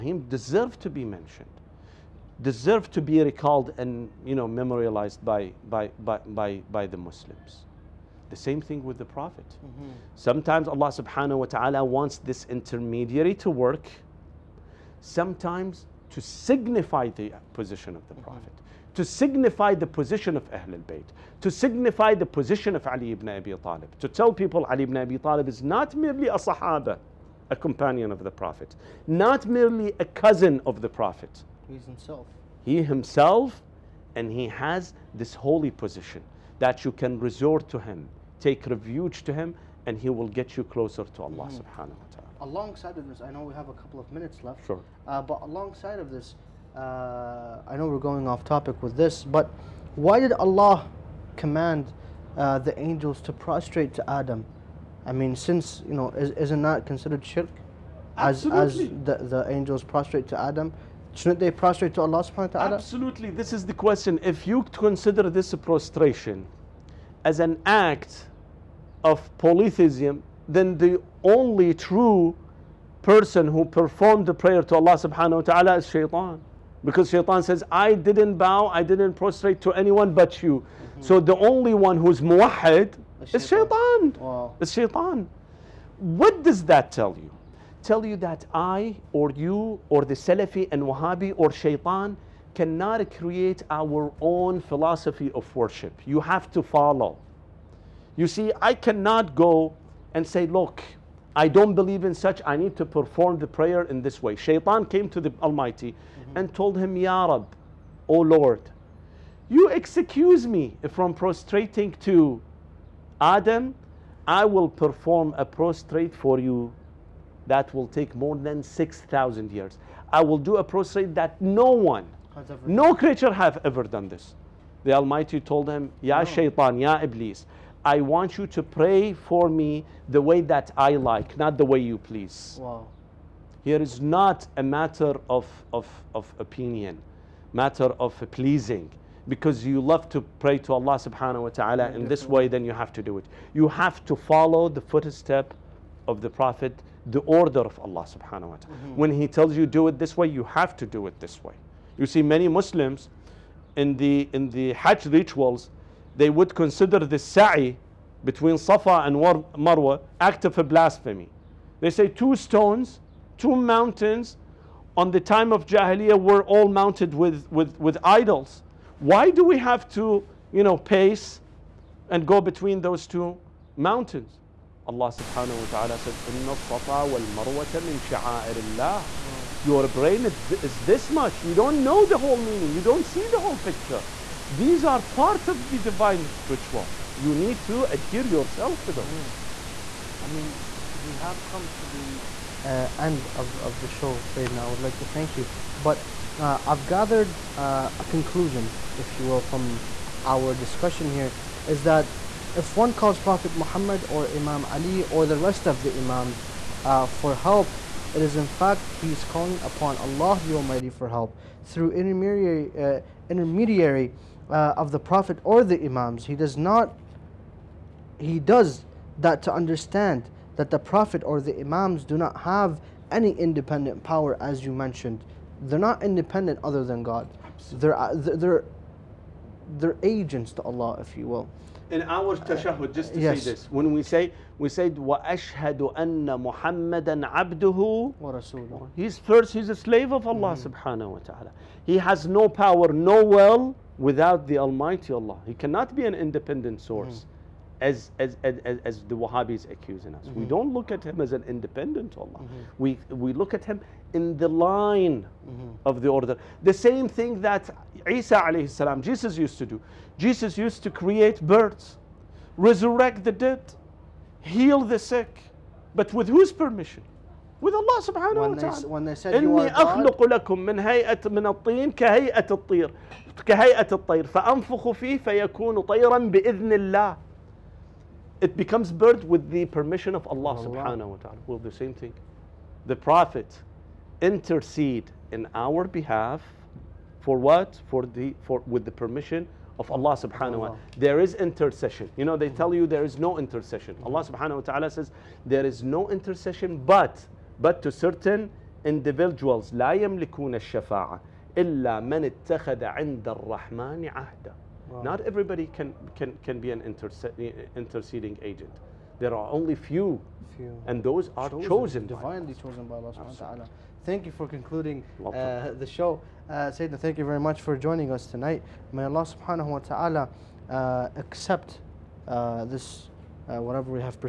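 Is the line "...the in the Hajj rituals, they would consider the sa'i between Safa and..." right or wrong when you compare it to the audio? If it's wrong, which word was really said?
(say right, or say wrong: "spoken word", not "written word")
right.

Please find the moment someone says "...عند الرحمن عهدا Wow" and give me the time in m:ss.
5:02.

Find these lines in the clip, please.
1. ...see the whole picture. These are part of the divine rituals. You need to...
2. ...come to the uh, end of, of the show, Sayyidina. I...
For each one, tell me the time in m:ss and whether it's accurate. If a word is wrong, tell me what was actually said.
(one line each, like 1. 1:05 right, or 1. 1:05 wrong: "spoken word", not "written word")
1. 3:03 right
2. 3:11 right.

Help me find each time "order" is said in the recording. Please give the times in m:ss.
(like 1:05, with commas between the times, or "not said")
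2:27, 4:16.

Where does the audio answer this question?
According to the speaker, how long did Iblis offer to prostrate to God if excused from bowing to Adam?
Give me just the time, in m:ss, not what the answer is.
1:58.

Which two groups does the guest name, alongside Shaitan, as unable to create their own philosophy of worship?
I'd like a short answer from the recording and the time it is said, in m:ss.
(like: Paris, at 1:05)
Salafi and Wahhabi, at 1:30.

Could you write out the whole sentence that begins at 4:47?
For the for with the permission of Allah subhanahu wa ta'ala.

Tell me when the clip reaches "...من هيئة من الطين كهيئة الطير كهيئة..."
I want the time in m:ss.
4:30.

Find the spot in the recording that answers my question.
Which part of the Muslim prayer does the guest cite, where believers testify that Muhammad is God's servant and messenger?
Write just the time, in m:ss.
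3:52.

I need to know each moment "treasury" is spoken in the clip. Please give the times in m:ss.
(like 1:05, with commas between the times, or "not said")
not said.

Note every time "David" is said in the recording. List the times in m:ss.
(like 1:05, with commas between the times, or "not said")
not said.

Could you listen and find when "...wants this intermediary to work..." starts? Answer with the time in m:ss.
0:11.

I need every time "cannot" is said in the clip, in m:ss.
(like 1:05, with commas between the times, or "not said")
1:32, 1:38, 4:05.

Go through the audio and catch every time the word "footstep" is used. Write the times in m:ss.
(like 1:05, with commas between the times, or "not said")
2:24.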